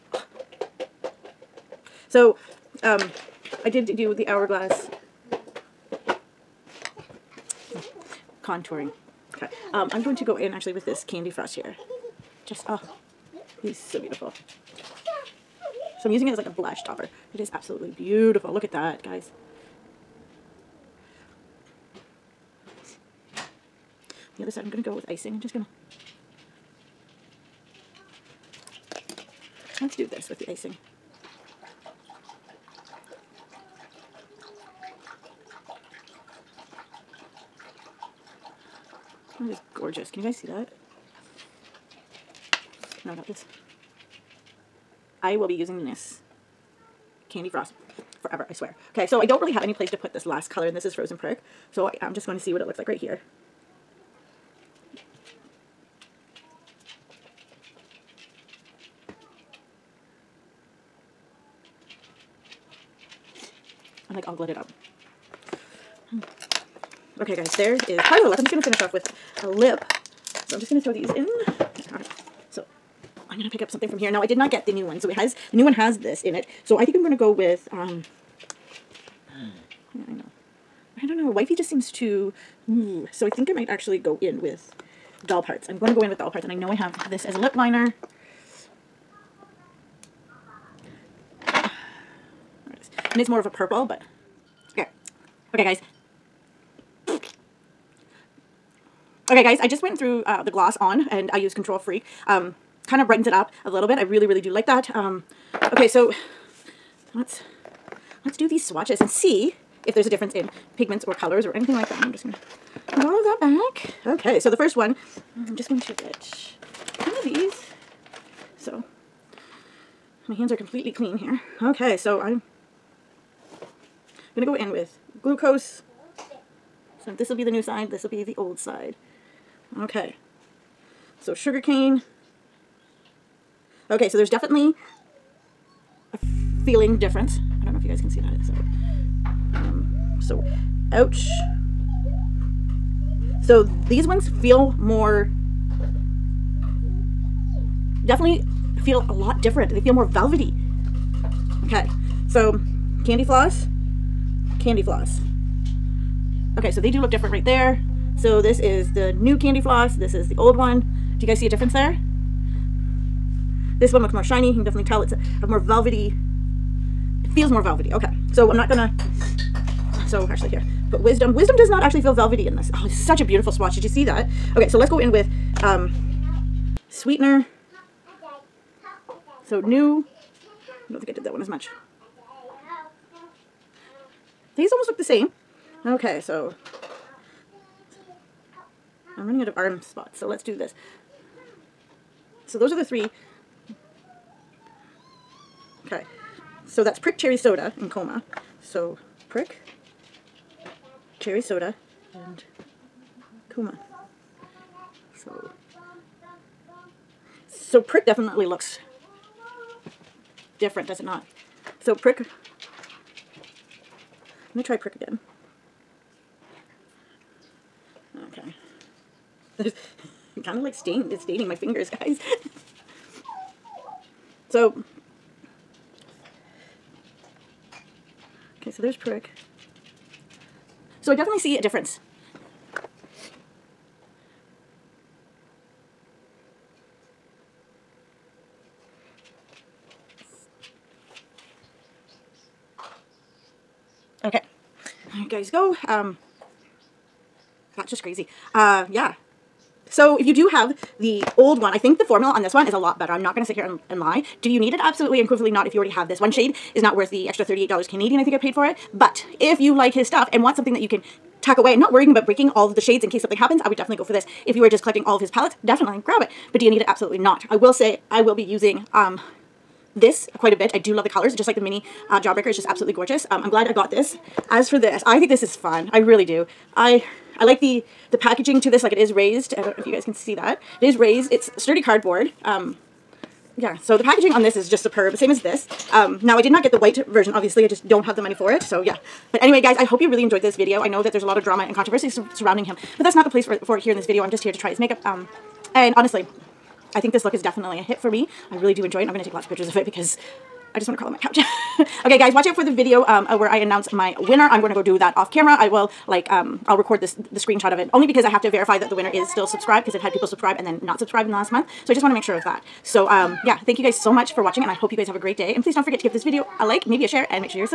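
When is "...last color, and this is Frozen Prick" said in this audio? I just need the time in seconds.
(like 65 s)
50 s.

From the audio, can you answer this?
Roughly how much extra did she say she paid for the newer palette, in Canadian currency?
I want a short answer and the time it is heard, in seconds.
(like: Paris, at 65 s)
$38, at 257 s.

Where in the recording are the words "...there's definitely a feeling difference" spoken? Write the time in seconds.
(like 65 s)
134 s.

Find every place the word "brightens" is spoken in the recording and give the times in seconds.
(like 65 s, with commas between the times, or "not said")
103 s.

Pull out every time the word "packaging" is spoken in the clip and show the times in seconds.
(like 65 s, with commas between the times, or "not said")
278 s, 284 s.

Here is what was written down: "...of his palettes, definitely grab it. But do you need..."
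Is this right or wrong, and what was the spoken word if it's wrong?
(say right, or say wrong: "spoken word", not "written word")
right.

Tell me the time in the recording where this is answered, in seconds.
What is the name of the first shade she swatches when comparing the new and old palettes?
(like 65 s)
125 s.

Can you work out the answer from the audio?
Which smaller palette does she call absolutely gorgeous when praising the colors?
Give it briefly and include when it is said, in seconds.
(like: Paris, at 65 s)
Jawbreaker, at 272 s.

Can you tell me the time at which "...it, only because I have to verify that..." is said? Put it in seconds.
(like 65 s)
307 s.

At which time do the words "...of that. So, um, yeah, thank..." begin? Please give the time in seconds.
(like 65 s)
312 s.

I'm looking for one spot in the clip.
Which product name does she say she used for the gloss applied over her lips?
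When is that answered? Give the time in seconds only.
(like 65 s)
101 s.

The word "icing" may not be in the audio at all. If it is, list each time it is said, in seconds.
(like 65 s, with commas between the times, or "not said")
25 s, 30 s.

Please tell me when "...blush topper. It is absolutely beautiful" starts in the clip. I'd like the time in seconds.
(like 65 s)
16 s.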